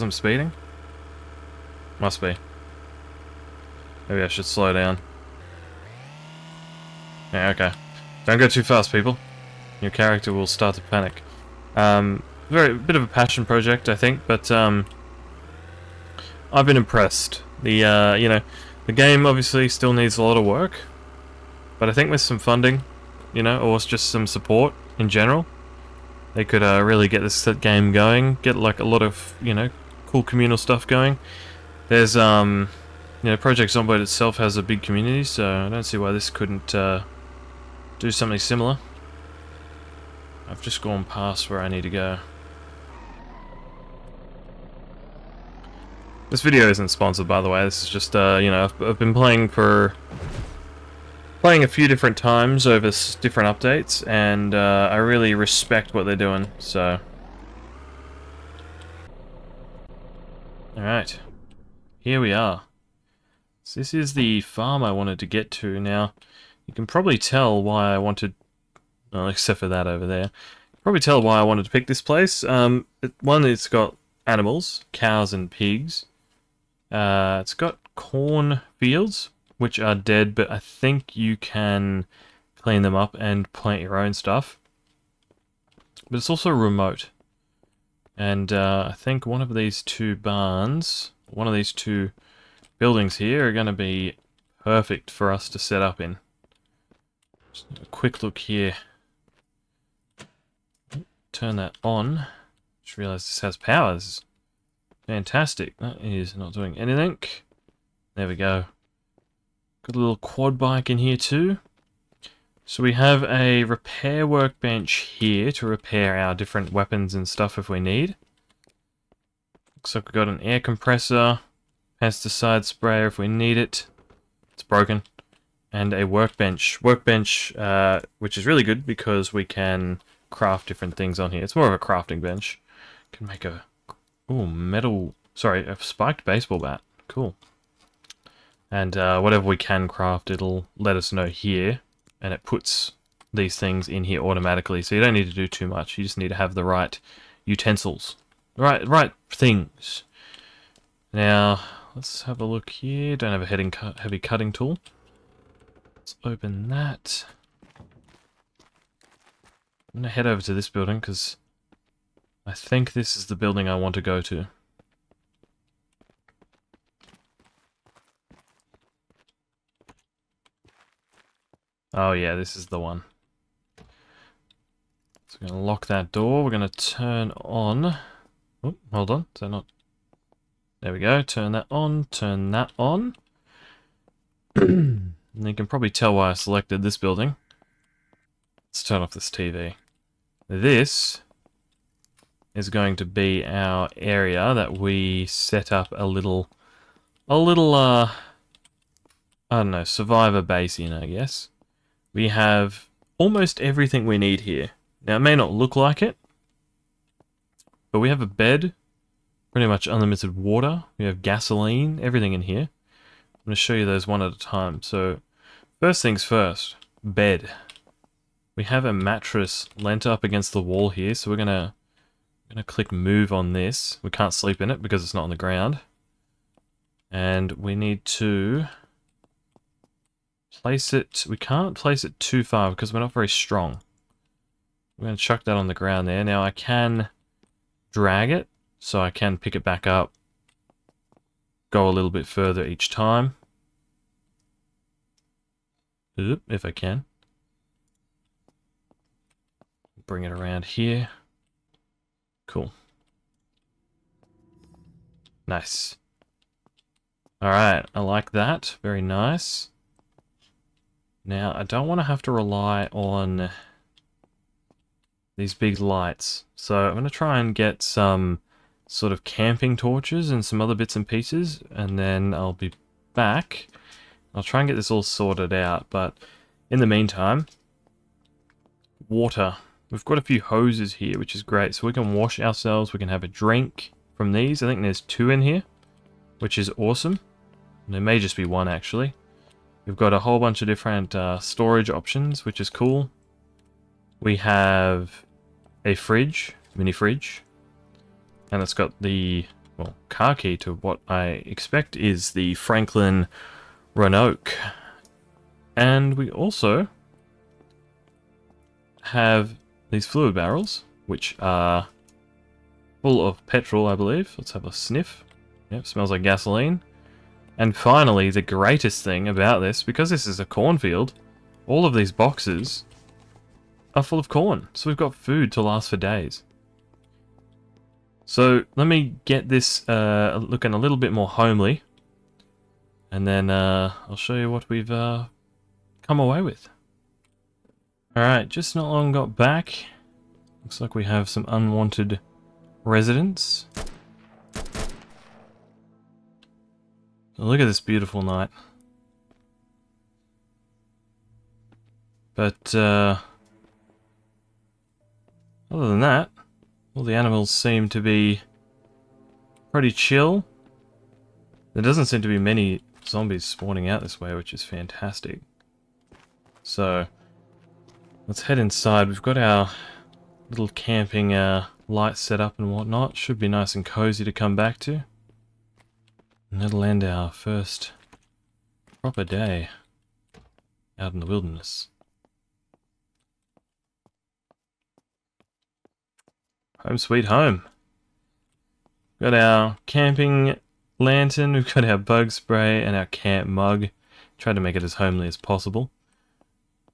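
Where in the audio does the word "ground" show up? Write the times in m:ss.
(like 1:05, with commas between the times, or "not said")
3:45, 3:55.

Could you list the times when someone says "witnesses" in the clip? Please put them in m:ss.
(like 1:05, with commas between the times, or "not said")
not said.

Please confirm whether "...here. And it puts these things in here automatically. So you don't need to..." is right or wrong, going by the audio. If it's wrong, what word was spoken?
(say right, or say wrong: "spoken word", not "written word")
right.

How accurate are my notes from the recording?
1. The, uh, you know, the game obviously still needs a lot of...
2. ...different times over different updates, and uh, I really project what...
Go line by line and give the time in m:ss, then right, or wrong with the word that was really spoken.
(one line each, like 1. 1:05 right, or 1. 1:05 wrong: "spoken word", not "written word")
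1. 0:17 right
2. 0:51 wrong: "respect", not "project".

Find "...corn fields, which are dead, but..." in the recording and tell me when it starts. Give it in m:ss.
1:17.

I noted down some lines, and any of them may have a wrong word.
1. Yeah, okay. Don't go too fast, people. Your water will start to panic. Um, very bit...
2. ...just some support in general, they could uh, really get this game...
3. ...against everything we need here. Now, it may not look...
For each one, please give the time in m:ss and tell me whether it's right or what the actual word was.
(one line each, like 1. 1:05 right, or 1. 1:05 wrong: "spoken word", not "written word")
1. 0:07 wrong: "character", not "water"
2. 0:23 right
3. 3:23 wrong: "almost", not "against".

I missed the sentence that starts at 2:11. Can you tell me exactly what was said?
It's more of a crafting bench.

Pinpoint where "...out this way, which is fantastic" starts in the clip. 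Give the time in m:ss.
6:03.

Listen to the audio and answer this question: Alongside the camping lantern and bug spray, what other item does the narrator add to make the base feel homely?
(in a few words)
Camp mug.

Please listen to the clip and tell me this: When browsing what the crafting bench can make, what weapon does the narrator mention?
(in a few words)
Spiked baseball bat.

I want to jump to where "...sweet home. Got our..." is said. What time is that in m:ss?
6:26.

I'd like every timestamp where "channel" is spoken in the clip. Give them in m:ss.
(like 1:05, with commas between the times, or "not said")
not said.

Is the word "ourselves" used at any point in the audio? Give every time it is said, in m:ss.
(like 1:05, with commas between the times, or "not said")
4:42.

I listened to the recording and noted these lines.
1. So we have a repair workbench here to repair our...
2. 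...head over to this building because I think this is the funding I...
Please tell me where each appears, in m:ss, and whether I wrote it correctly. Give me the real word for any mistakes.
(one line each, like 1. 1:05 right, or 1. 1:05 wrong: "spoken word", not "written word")
1. 1:52 right
2. 2:40 wrong: "building", not "funding".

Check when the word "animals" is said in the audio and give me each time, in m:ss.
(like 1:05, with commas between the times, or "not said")
1:14, 5:57.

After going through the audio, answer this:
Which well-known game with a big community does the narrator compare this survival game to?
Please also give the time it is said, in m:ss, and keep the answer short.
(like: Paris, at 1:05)
Project Zomboid, at 0:33.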